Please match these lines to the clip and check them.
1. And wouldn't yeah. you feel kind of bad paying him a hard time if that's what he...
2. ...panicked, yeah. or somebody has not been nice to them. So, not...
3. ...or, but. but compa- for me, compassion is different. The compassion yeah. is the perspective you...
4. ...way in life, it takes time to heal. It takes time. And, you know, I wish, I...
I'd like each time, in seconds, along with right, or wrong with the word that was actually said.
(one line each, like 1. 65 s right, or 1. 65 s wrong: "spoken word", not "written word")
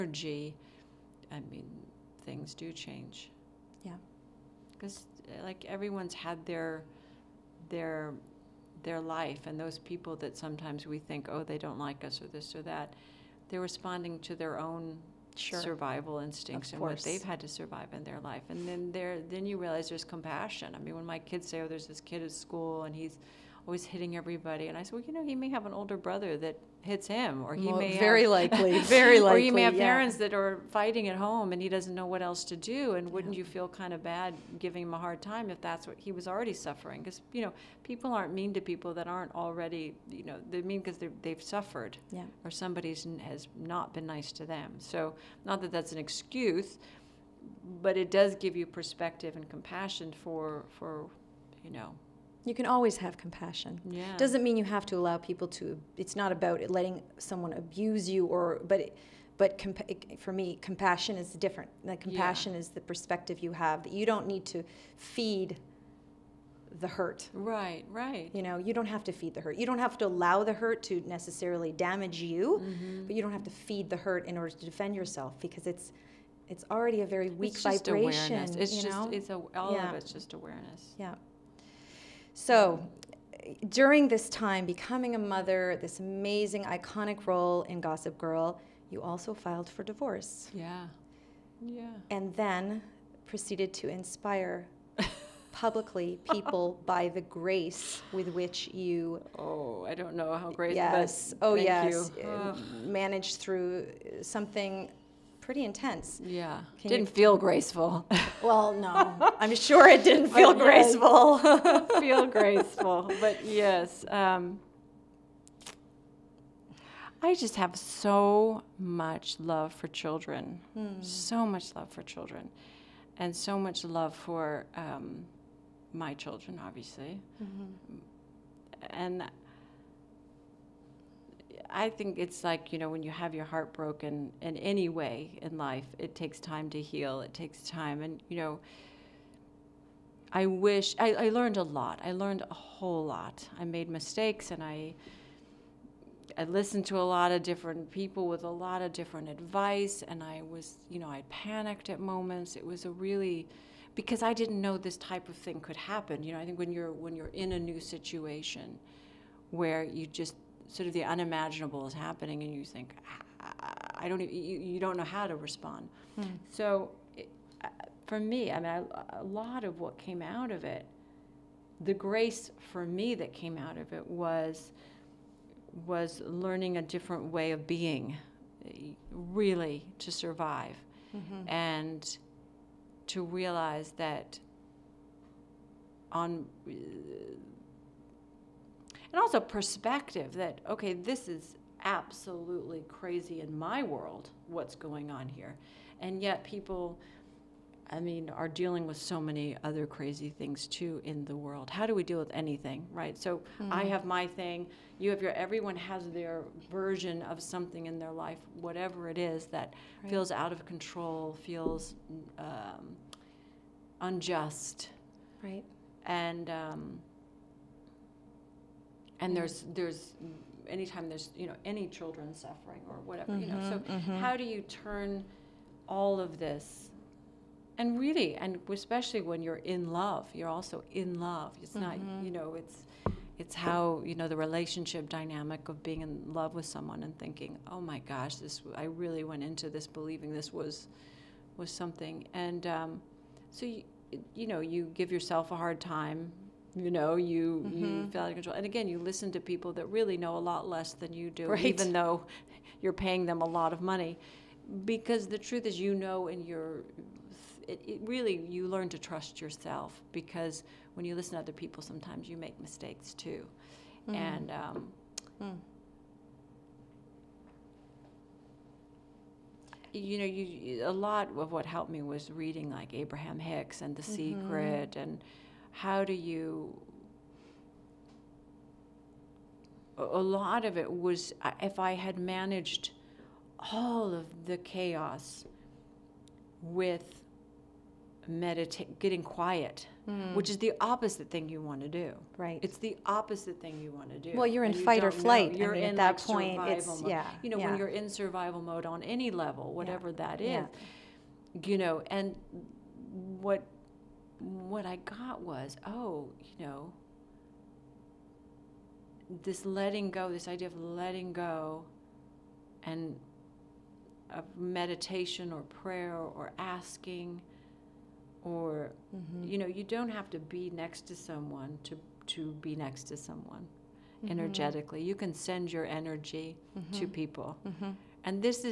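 1. 32 s wrong: "giving", not "paying"
2. 41 s wrong: "suffered", not "panicked"
3. 58 s right
4. 134 s right.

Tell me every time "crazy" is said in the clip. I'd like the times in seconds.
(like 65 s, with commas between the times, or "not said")
192 s, 199 s.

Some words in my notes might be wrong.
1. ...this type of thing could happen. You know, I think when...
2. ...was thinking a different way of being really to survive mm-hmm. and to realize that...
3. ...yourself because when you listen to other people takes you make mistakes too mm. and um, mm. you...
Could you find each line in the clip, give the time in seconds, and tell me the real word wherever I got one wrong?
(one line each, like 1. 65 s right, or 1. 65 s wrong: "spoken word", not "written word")
1. 154 s right
2. 175 s wrong: "learning", not "thinking"
3. 259 s wrong: "sometimes", not "takes".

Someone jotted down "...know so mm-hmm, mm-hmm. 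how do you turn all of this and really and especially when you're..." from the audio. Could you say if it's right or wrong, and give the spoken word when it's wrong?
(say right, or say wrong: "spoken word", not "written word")
right.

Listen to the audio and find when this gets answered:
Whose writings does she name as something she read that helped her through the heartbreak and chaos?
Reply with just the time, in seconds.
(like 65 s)
272 s.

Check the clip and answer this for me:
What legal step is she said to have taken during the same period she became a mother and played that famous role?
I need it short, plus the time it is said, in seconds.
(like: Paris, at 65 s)
divorce, at 89 s.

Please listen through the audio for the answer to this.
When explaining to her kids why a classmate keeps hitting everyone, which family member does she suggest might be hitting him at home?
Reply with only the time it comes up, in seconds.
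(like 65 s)
25 s.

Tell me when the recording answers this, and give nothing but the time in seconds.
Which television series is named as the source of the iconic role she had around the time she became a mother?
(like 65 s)
87 s.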